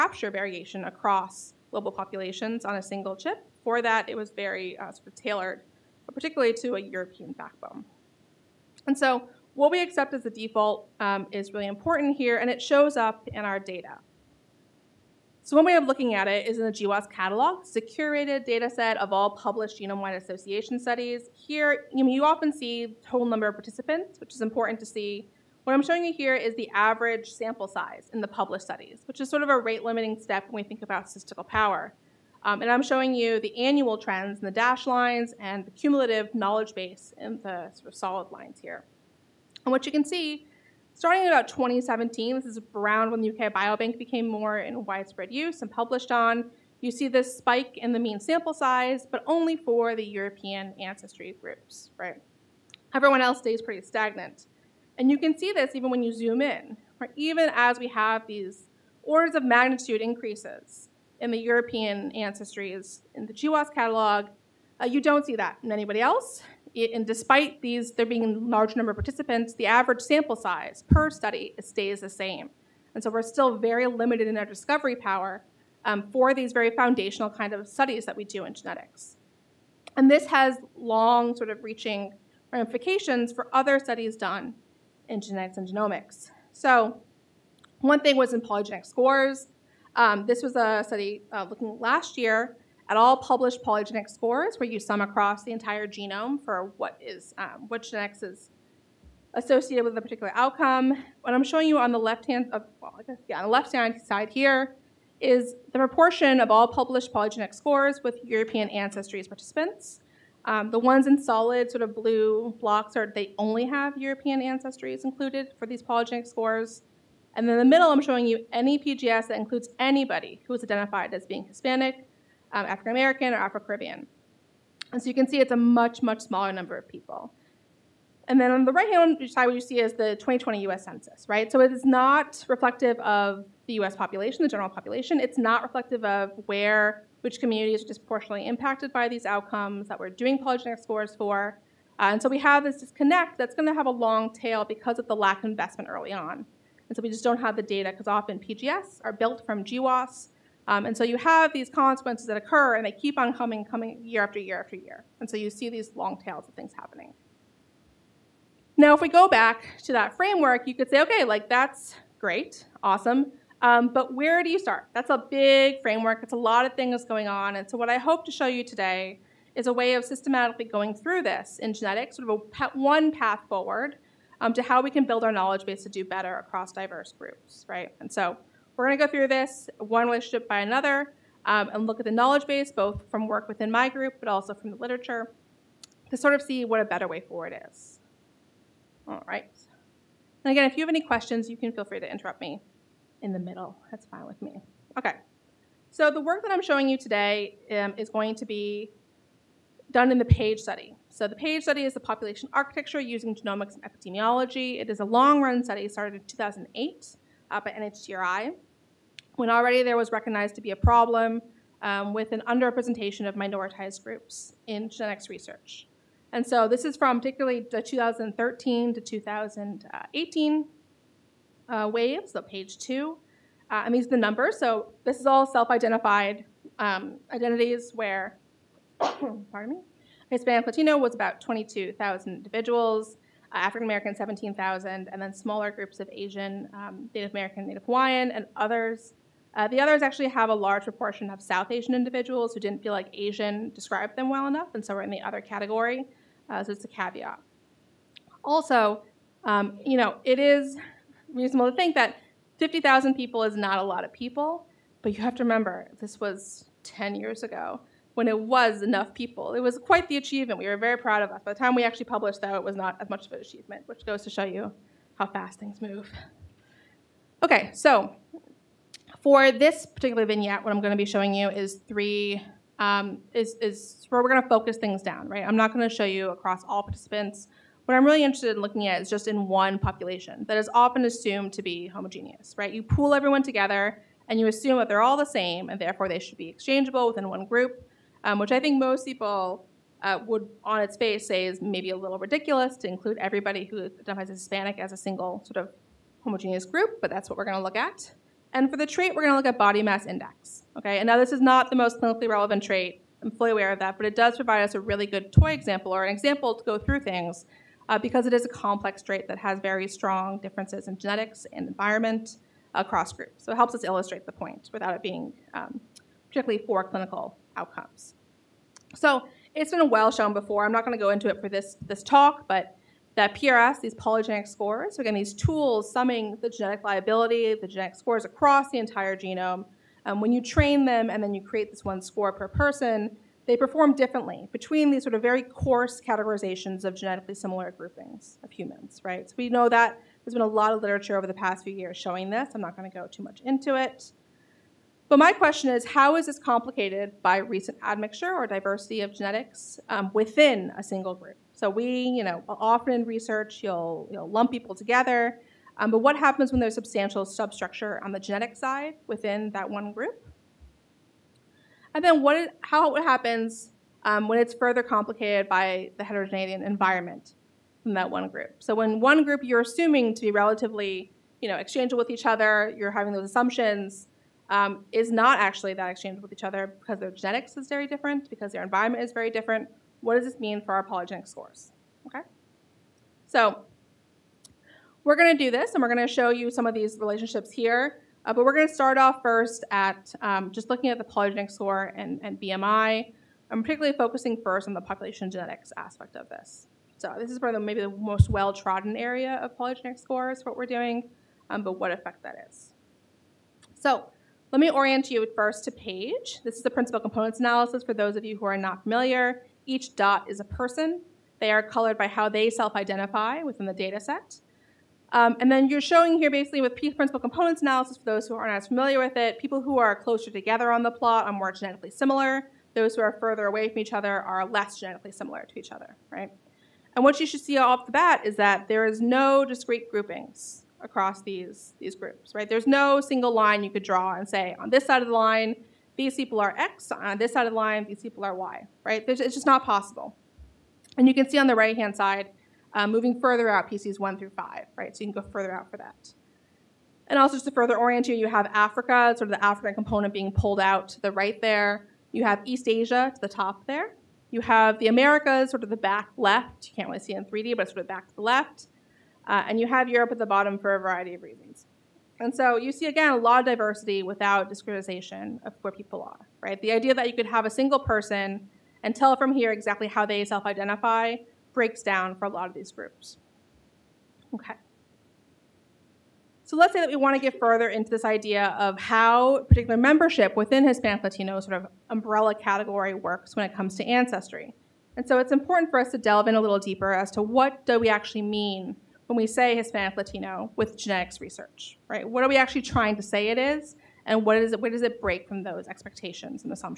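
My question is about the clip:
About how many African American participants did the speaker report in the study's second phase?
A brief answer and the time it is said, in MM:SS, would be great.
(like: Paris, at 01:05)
17,000, at 03:54.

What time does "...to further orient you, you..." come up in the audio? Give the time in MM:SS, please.
07:27.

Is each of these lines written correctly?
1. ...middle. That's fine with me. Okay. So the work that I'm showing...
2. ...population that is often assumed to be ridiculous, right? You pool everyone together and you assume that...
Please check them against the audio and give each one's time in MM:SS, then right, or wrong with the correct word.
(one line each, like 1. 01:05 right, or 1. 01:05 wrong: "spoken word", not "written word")
1. 03:13 right
2. 04:39 wrong: "homogeneous", not "ridiculous".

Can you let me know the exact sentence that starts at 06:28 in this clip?
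Uh, but we're going to start off first at um, just looking at the polygenic score and, and BMI.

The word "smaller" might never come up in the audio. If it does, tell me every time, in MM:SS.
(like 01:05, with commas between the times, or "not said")
02:06, 03:55.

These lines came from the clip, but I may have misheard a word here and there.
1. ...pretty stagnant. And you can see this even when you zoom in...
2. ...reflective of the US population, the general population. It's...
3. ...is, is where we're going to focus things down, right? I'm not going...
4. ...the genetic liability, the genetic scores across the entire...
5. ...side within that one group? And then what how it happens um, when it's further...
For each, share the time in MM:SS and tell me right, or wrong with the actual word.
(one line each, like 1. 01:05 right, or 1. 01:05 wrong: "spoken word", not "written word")
1. 00:53 right
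2. 02:12 right
3. 04:33 right
4. 05:26 right
5. 05:58 right.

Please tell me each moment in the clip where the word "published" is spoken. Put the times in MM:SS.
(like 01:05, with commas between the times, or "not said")
00:19, 00:28, 00:45, 01:33, 01:46, 04:22.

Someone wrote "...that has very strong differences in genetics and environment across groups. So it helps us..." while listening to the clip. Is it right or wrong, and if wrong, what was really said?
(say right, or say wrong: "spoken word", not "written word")
right.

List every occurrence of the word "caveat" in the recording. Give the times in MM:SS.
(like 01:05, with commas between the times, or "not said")
04:06.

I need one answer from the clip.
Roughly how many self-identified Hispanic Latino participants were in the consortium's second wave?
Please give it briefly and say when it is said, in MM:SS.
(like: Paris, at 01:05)
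22,000, at 03:51.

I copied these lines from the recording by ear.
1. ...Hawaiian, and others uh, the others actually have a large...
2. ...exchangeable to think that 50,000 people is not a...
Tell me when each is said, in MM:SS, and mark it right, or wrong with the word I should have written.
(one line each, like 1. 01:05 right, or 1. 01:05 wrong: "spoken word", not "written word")
1. 03:57 right
2. 04:11 wrong: "reasonable", not "exchangeable".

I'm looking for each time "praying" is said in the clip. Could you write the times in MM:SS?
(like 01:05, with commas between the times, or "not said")
not said.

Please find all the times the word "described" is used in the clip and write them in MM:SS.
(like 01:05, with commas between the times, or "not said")
04:03.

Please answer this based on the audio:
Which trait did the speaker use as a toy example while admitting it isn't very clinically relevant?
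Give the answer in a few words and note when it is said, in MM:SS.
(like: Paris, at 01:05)
Body mass index, at 04:59.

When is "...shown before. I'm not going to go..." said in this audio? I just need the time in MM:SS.
05:20.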